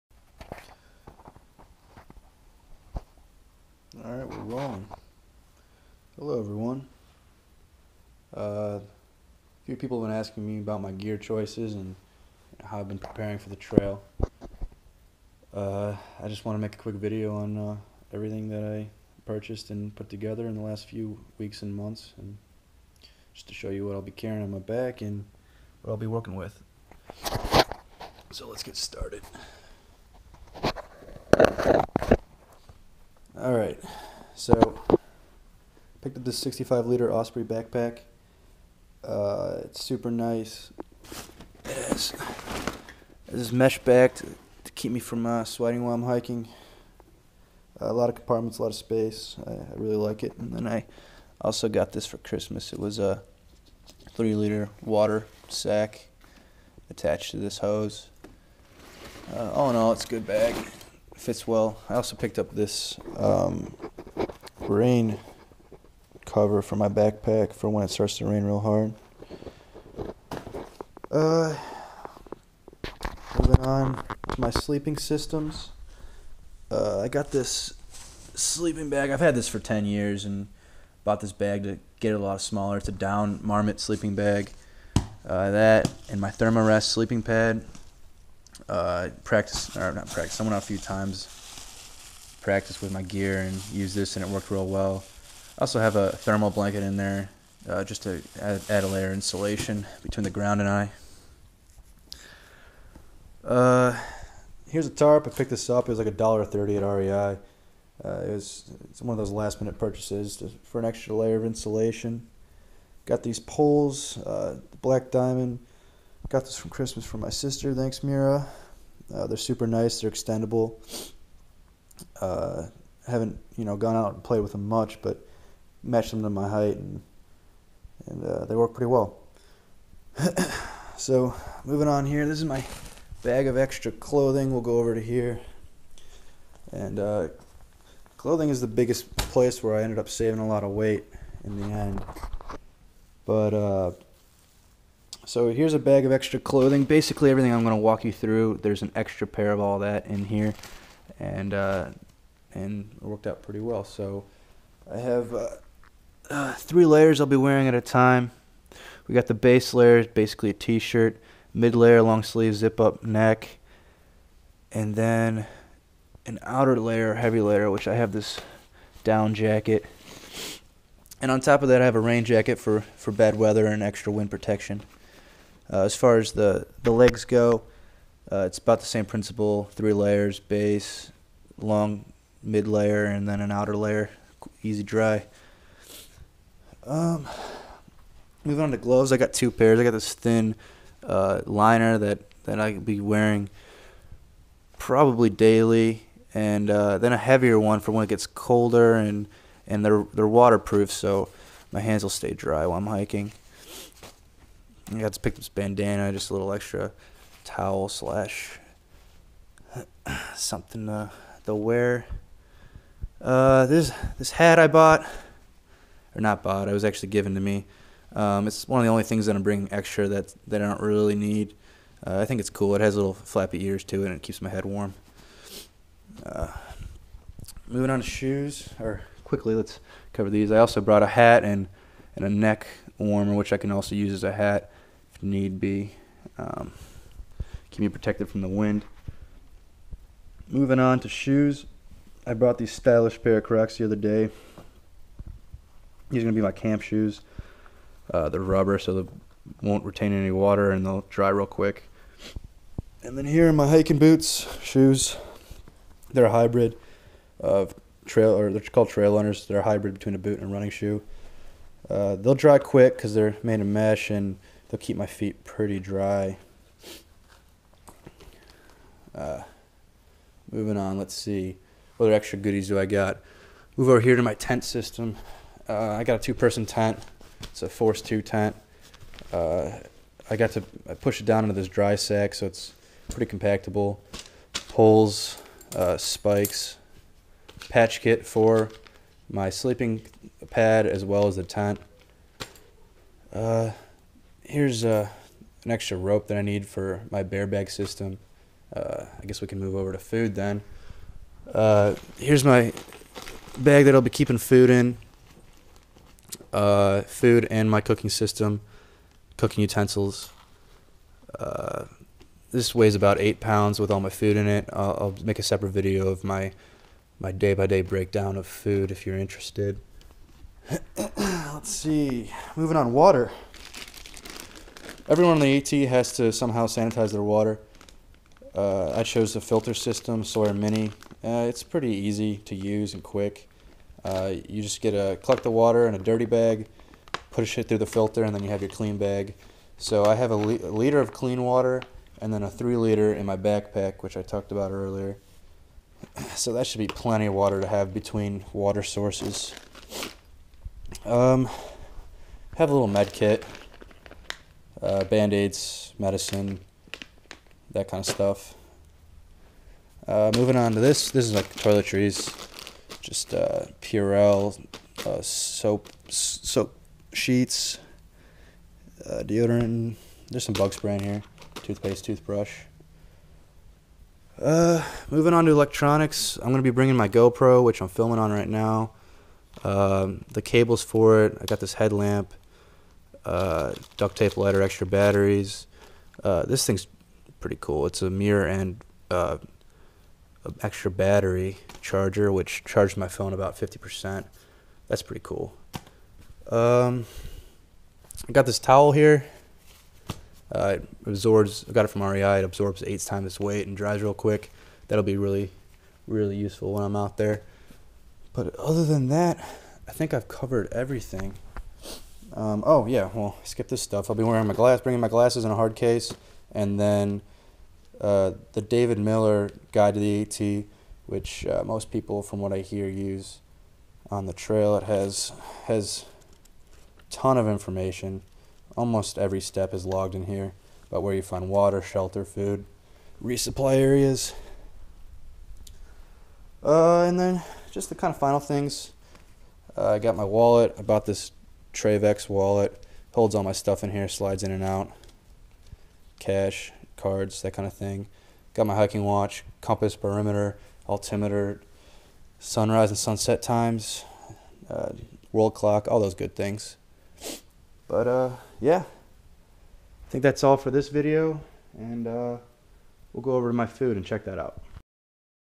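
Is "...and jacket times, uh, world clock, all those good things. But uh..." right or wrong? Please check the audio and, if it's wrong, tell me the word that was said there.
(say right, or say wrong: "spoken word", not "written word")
wrong: "sunset", not "jacket".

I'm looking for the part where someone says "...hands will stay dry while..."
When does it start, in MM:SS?
03:21.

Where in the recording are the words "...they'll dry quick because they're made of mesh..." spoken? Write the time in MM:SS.
04:22.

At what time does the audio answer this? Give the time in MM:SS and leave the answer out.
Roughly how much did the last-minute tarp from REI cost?
01:46.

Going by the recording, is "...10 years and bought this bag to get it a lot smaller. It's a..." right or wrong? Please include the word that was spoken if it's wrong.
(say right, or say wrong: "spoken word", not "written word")
right.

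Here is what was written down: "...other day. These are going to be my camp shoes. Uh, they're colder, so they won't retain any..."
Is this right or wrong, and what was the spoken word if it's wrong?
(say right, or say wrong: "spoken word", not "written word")
wrong: "rubber", not "colder".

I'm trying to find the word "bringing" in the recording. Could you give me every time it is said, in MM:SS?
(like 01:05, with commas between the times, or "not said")
03:39, 06:16, 06:54.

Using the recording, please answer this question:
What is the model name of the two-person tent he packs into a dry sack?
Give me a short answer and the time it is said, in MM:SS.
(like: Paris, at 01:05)
Force 2, at 04:37.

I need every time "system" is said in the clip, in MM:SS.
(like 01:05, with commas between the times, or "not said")
01:14, 04:34, 04:57, 05:08, 05:29.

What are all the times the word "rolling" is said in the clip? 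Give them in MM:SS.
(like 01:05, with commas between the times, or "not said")
00:04.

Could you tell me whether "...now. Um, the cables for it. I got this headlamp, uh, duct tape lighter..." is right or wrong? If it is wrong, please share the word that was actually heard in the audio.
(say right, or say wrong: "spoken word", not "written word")
right.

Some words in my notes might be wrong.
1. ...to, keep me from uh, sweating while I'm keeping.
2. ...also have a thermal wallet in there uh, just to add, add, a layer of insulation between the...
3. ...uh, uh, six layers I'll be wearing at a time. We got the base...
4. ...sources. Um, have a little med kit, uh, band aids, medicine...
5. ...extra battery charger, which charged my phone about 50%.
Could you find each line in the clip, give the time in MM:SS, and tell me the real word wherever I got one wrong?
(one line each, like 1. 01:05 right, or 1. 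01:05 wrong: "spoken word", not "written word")
1. 00:44 wrong: "hiking", not "keeping"
2. 01:35 wrong: "blanket", not "wallet"
3. 02:35 wrong: "three", not "six"
4. 05:48 right
5. 06:30 right.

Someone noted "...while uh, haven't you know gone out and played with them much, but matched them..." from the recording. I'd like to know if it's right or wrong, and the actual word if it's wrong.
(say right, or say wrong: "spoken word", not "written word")
wrong: "extendable", not "while".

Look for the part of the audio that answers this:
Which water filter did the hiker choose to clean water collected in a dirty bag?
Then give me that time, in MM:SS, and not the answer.
05:30.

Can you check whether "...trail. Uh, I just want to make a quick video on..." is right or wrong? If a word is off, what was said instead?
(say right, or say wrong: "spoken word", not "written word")
right.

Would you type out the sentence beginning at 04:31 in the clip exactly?
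What other extra goodies do I got?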